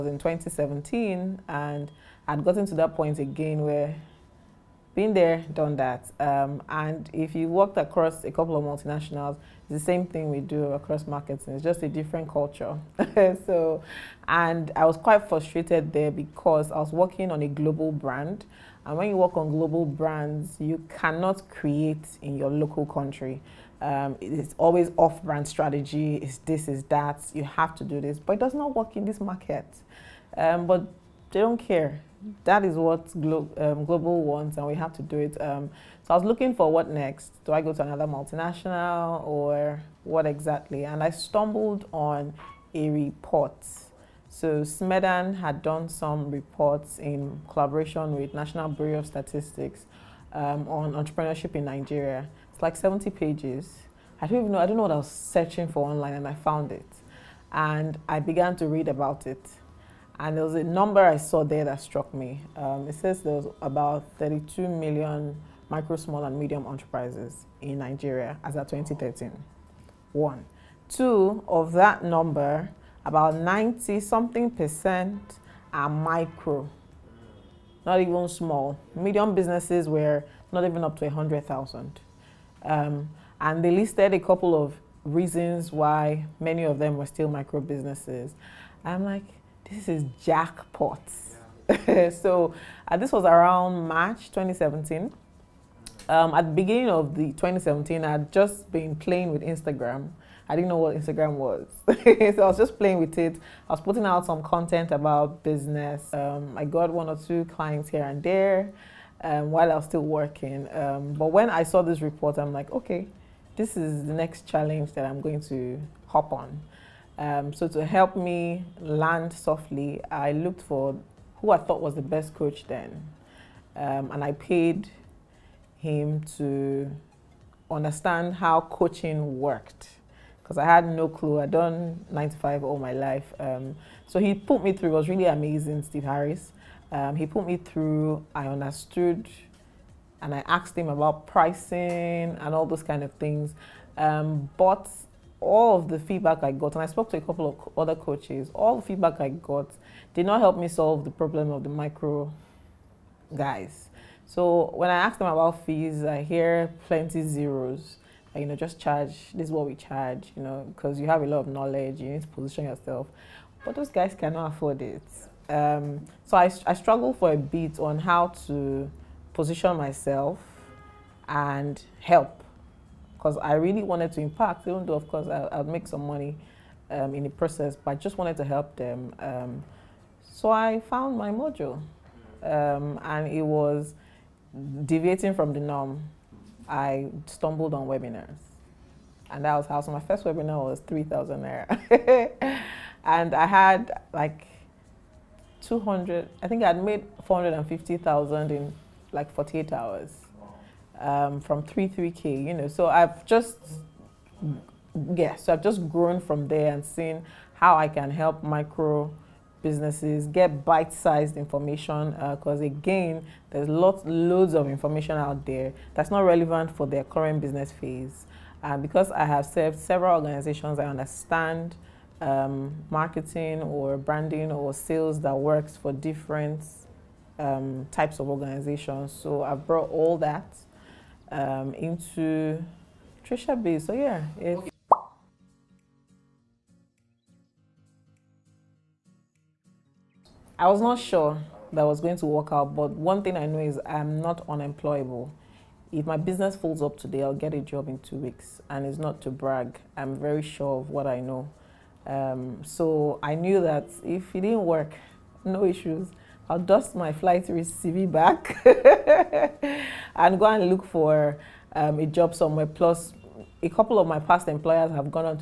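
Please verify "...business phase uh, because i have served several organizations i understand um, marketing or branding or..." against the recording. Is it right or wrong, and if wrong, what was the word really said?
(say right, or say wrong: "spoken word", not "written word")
right.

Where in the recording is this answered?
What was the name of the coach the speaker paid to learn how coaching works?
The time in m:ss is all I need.
2:15.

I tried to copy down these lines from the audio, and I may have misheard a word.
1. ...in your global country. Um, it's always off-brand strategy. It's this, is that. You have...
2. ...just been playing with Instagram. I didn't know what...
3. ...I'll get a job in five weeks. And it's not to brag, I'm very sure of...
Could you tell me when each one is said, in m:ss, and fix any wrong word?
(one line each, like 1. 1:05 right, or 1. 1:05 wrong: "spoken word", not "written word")
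1. 0:22 wrong: "local", not "global"
2. 1:38 right
3. 4:07 wrong: "two", not "five".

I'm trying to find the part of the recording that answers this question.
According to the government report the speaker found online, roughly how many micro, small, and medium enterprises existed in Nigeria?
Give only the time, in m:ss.
1:04.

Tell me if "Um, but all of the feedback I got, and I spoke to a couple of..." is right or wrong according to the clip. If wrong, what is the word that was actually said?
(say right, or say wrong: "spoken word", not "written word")
right.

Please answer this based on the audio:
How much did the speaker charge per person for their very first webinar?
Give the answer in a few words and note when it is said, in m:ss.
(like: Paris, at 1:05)
3,000 naira, at 3:10.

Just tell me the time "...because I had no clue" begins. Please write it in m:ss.
2:10.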